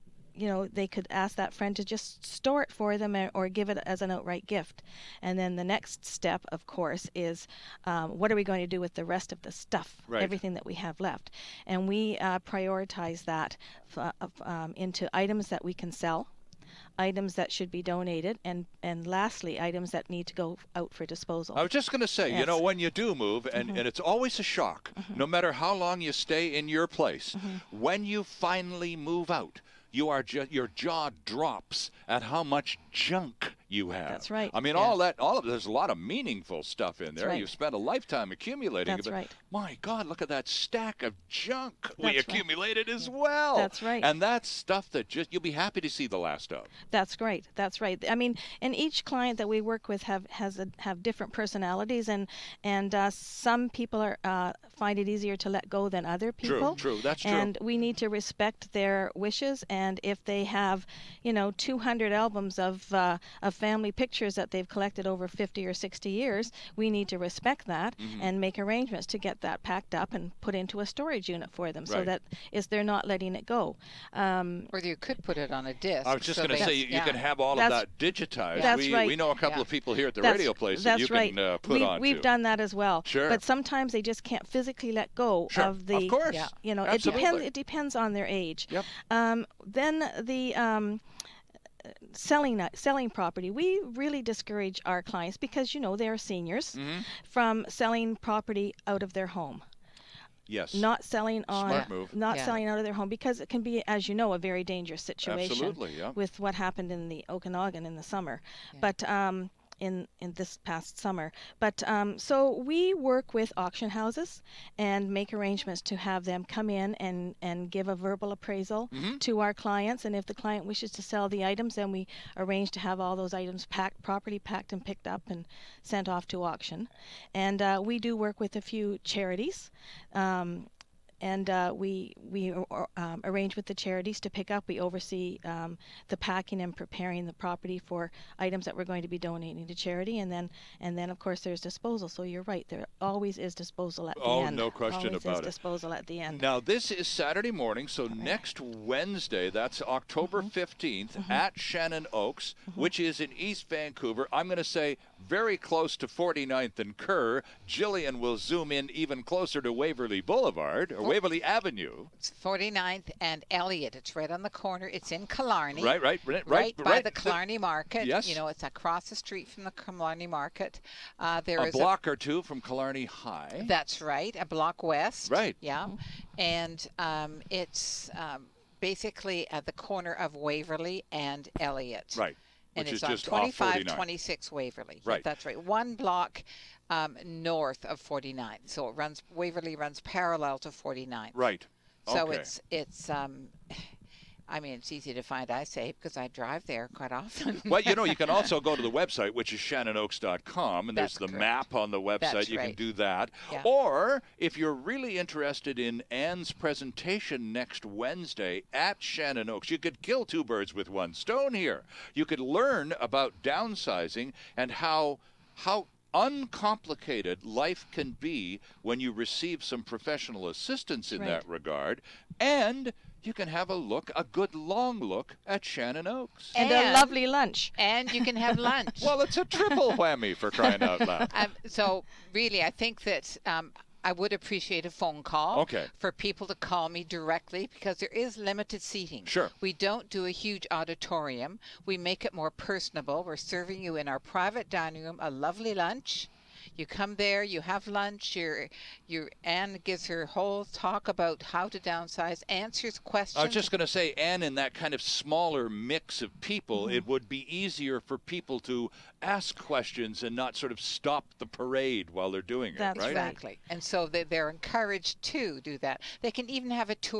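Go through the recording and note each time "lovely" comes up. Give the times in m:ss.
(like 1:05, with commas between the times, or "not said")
3:46, 4:05.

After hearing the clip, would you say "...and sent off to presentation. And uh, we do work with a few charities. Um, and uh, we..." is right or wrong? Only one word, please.
wrong.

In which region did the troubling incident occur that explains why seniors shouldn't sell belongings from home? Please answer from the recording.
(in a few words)
Okanagan.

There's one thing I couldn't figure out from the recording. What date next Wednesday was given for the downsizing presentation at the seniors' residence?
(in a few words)
October 15.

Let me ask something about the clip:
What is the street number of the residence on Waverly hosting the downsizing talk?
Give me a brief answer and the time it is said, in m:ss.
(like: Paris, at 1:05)
2526, at 3:03.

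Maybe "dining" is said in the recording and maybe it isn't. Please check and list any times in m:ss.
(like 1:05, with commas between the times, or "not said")
4:04.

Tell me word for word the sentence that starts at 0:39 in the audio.
My God, look at that stack of junk that's we accumulated right.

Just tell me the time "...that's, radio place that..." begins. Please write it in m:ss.
1:20.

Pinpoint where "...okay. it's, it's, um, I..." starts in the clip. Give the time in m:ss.
3:12.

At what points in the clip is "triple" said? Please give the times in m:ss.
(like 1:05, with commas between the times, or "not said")
3:49.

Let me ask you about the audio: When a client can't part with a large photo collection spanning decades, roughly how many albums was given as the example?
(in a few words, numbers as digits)
200.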